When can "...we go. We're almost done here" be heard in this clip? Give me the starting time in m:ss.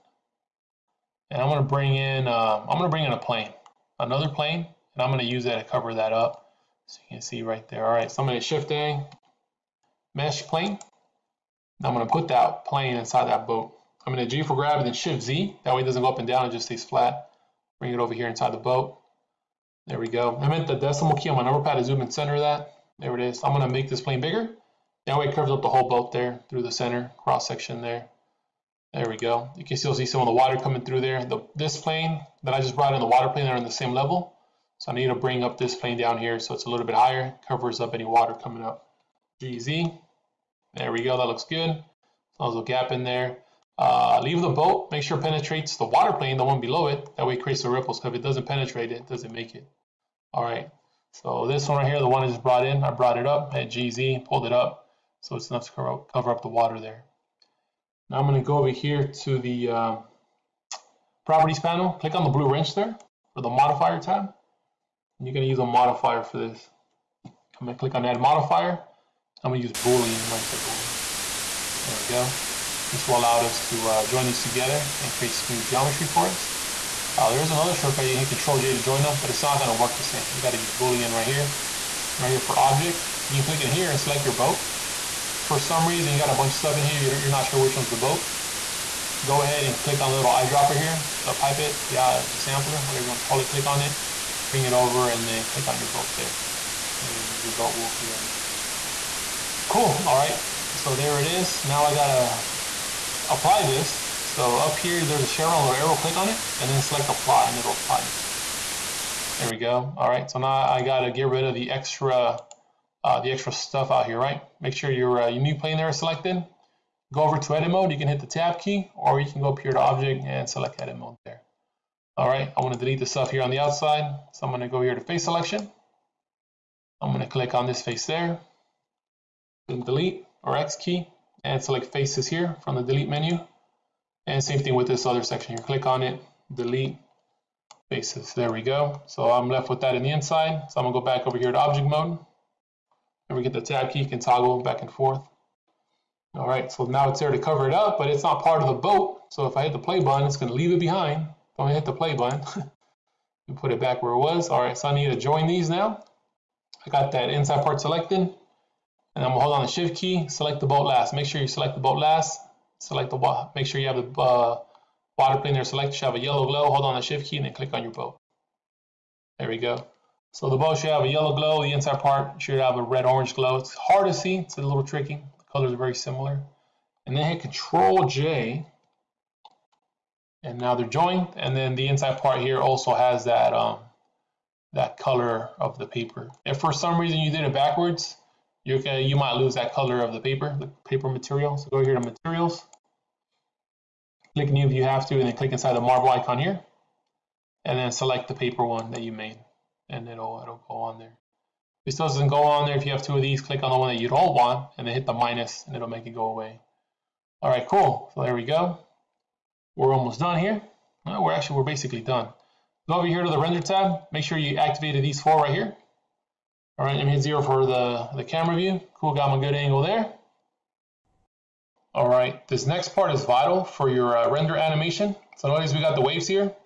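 3:28.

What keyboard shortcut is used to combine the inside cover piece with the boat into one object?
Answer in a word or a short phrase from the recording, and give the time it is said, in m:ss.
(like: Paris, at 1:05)
Control-J, at 2:57.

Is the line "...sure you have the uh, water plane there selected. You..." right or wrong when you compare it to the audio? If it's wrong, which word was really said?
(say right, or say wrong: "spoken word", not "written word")
right.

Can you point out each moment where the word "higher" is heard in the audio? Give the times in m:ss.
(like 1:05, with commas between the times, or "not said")
0:36.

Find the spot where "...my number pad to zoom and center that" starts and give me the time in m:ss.
0:21.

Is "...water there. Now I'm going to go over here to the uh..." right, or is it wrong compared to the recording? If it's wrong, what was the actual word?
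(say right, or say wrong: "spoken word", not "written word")
right.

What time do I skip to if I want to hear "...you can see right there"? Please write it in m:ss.
0:07.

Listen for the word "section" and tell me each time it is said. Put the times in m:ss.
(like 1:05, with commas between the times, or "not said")
0:27, 2:15.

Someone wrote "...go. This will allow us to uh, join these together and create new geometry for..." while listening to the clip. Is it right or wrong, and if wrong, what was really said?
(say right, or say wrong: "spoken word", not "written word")
right.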